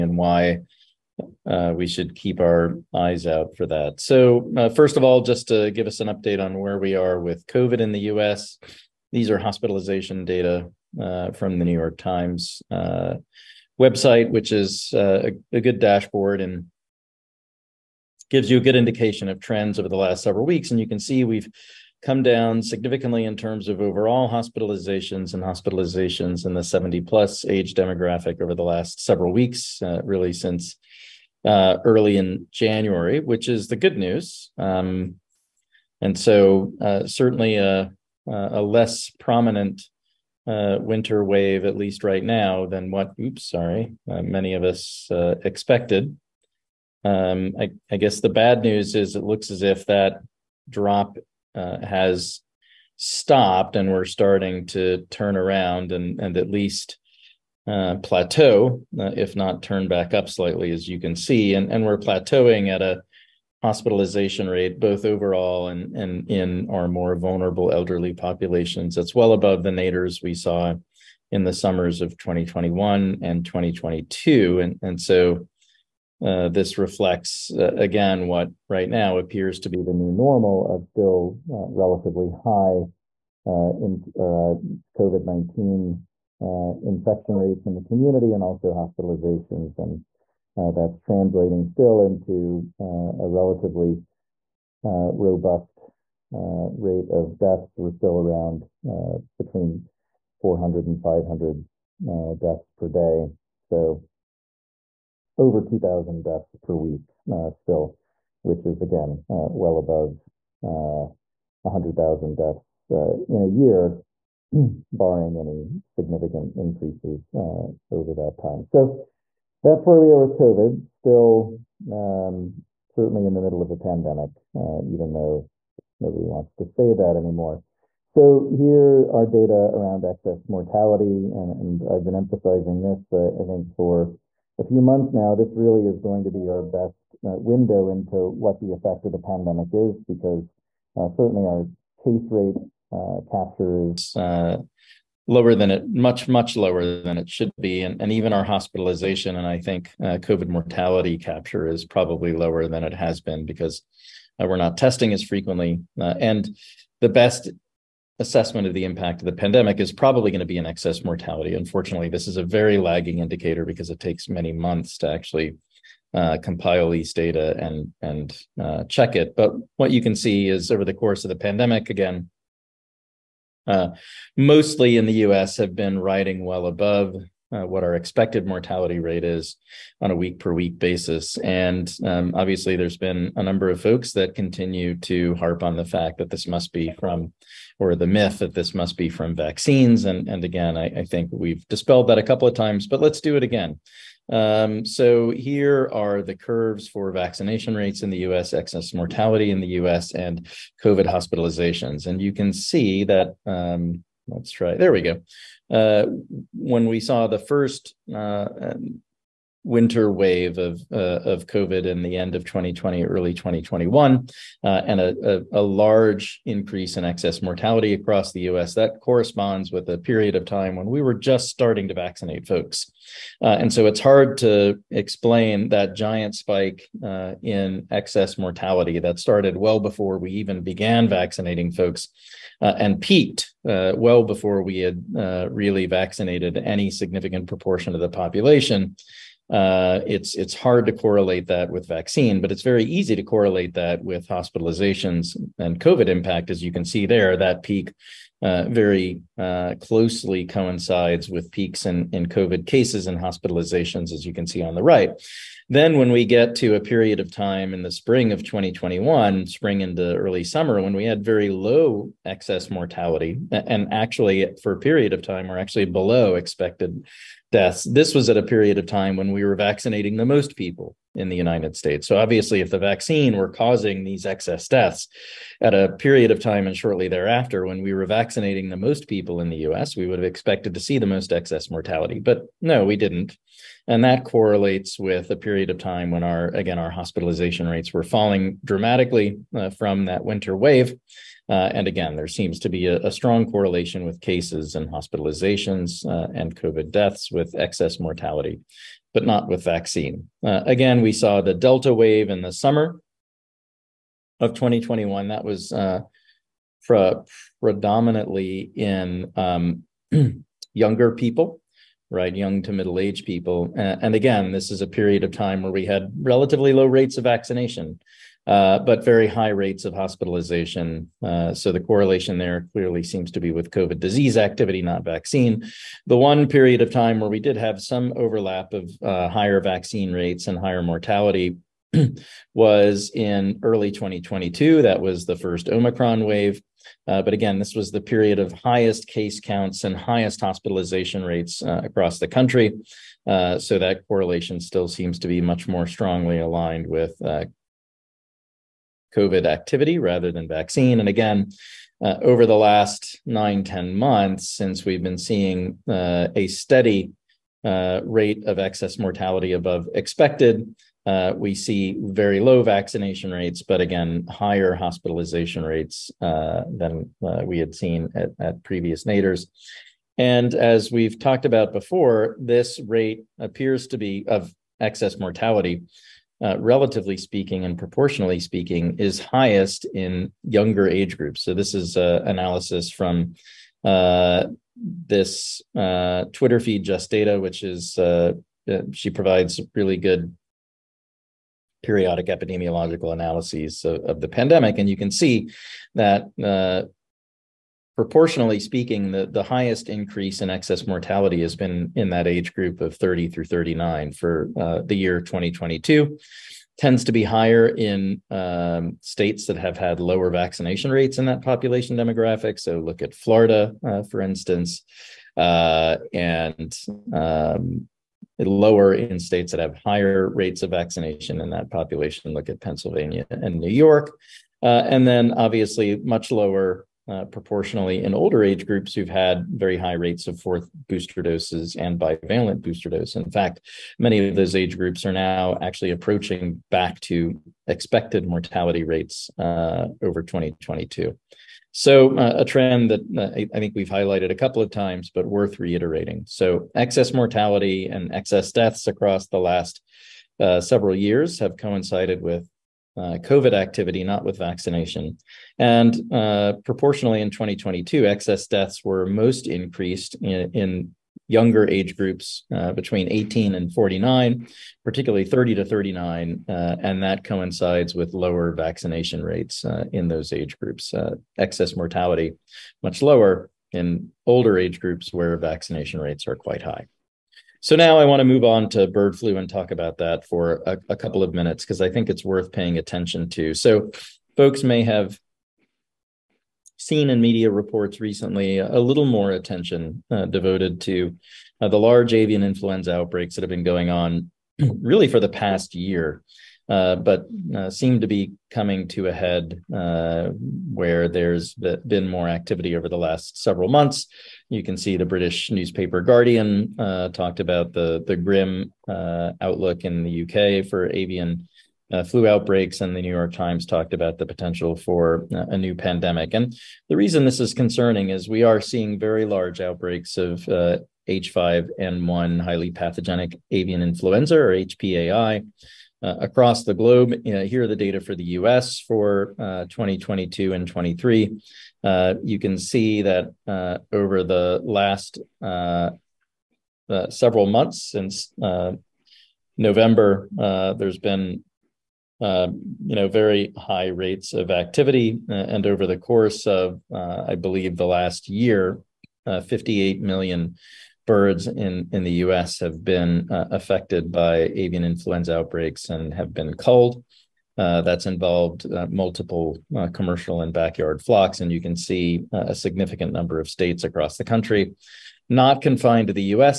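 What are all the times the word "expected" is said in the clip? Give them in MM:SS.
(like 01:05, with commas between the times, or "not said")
00:45, 02:57, 04:26, 04:40, 05:59, 07:17.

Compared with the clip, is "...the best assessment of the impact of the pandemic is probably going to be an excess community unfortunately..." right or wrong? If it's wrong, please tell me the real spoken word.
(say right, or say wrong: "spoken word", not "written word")
wrong: "mortality", not "community".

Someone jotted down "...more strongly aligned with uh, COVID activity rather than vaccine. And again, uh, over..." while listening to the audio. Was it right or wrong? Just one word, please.
right.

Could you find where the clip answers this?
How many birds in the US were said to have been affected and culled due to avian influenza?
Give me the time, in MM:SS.
09:09.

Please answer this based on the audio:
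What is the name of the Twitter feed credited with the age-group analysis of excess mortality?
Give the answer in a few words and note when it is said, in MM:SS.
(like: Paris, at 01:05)
Just Data, at 06:26.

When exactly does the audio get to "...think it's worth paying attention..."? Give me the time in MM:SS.
08:01.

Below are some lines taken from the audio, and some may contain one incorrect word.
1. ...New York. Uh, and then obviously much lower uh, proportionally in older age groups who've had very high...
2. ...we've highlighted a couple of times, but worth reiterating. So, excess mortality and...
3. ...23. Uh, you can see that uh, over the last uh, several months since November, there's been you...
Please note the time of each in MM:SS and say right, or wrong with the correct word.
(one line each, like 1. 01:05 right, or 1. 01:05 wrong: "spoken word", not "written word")
1. 07:03 right
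2. 07:23 right
3. 08:50 right.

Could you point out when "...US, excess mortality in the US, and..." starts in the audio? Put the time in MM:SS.
03:18.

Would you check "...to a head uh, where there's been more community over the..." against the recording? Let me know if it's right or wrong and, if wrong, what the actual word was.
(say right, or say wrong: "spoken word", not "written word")
wrong: "activity", not "community".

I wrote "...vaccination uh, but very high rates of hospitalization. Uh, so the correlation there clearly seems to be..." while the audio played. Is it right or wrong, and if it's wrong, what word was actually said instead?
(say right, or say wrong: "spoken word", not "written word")
right.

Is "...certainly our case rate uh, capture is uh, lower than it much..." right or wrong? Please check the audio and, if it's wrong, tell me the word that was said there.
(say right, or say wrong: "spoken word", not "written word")
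right.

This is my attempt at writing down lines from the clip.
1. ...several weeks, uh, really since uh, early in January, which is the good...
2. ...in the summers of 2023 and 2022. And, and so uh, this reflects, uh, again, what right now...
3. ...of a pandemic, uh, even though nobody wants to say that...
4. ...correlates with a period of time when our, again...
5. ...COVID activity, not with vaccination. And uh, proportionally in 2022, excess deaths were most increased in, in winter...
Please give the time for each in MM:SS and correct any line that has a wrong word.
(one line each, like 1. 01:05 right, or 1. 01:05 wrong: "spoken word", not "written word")
1. 00:29 right
2. 01:11 wrong: "2021", not "2023"
3. 02:03 right
4. 04:44 right
5. 07:33 wrong: "younger", not "winter".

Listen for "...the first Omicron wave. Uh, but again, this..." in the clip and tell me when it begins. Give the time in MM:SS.
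05:35.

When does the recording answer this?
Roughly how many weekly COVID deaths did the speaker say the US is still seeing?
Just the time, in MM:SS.
01:45.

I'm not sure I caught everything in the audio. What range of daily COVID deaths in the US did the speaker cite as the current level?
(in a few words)
400 to 500.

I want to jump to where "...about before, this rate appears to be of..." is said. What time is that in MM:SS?
06:11.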